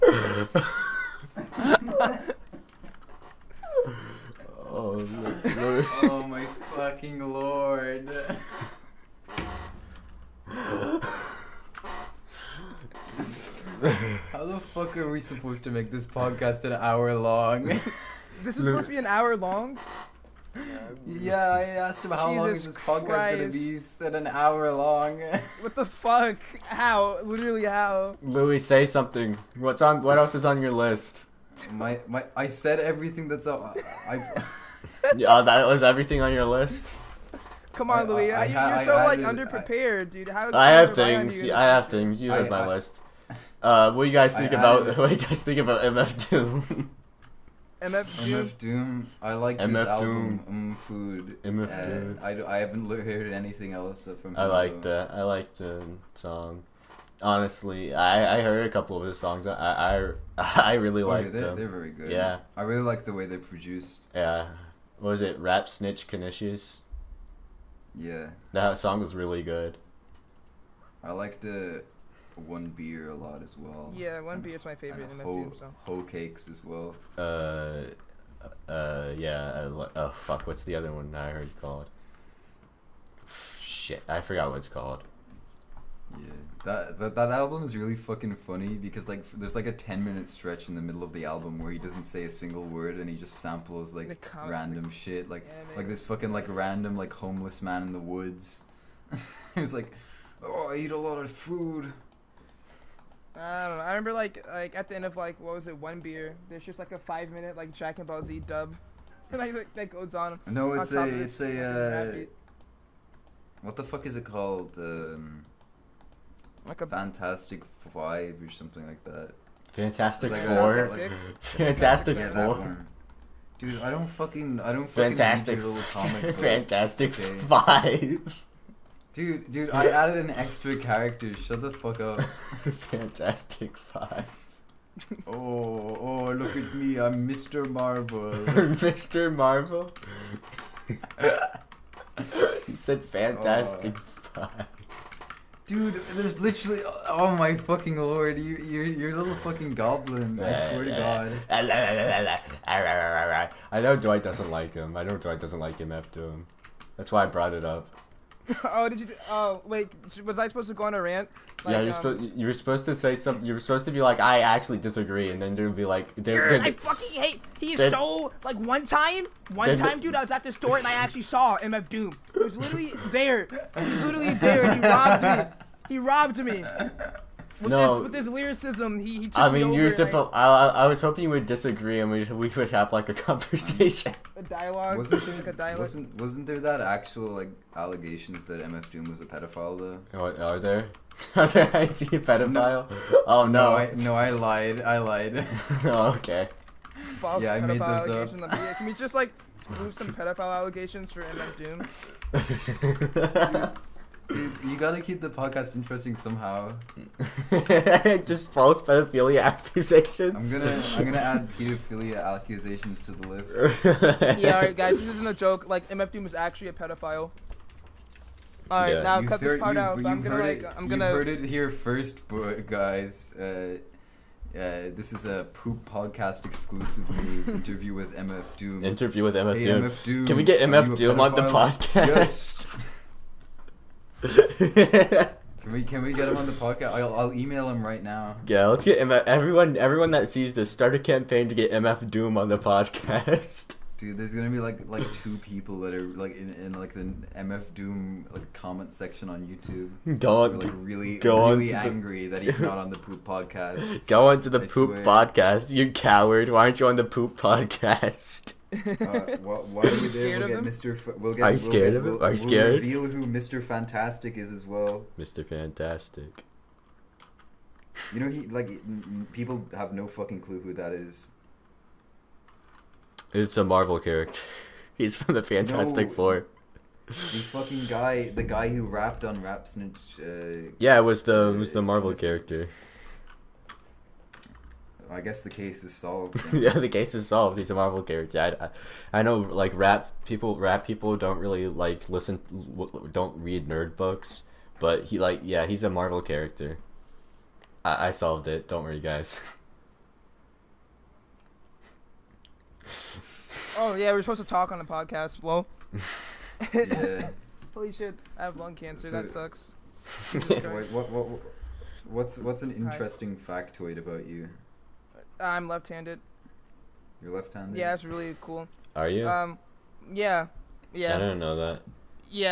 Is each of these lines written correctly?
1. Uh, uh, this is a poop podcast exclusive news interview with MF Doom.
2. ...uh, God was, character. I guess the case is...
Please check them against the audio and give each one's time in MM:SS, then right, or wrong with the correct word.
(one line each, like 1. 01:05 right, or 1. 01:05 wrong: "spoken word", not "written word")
1. 03:43 right
2. 04:41 wrong: "Marvel", not "God".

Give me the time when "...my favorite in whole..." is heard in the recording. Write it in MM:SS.
01:14.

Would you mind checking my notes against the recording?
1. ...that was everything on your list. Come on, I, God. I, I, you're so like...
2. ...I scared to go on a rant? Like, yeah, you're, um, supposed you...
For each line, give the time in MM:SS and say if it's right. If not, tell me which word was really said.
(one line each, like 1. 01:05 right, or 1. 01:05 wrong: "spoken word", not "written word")
1. 00:35 wrong: "Louis", not "God"
2. 02:40 wrong: "supposed", not "scared".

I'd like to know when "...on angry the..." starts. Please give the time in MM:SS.
04:11.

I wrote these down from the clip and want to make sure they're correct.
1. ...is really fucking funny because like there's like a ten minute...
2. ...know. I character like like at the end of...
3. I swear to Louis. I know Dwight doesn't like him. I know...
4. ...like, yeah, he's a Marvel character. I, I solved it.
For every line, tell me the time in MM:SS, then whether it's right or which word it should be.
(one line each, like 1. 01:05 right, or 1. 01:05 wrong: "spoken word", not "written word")
1. 01:27 right
2. 01:43 wrong: "remember", not "character"
3. 02:30 wrong: "God", not "Louis"
4. 04:55 right.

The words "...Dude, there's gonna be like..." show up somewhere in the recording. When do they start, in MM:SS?
04:03.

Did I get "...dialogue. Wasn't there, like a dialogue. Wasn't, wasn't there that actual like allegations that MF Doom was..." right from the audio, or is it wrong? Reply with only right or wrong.
right.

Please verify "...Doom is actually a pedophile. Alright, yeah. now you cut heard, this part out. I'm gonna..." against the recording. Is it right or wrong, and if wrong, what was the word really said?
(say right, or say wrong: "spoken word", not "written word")
right.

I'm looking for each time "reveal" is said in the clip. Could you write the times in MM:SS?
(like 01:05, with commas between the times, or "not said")
04:23.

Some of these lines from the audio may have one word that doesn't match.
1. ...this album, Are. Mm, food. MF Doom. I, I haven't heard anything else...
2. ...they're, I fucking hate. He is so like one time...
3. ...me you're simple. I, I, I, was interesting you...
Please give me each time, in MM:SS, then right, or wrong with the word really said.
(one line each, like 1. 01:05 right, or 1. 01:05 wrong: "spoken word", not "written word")
1. 00:49 wrong: "Doom", not "Are"
2. 02:46 right
3. 02:59 wrong: "hoping", not "interesting".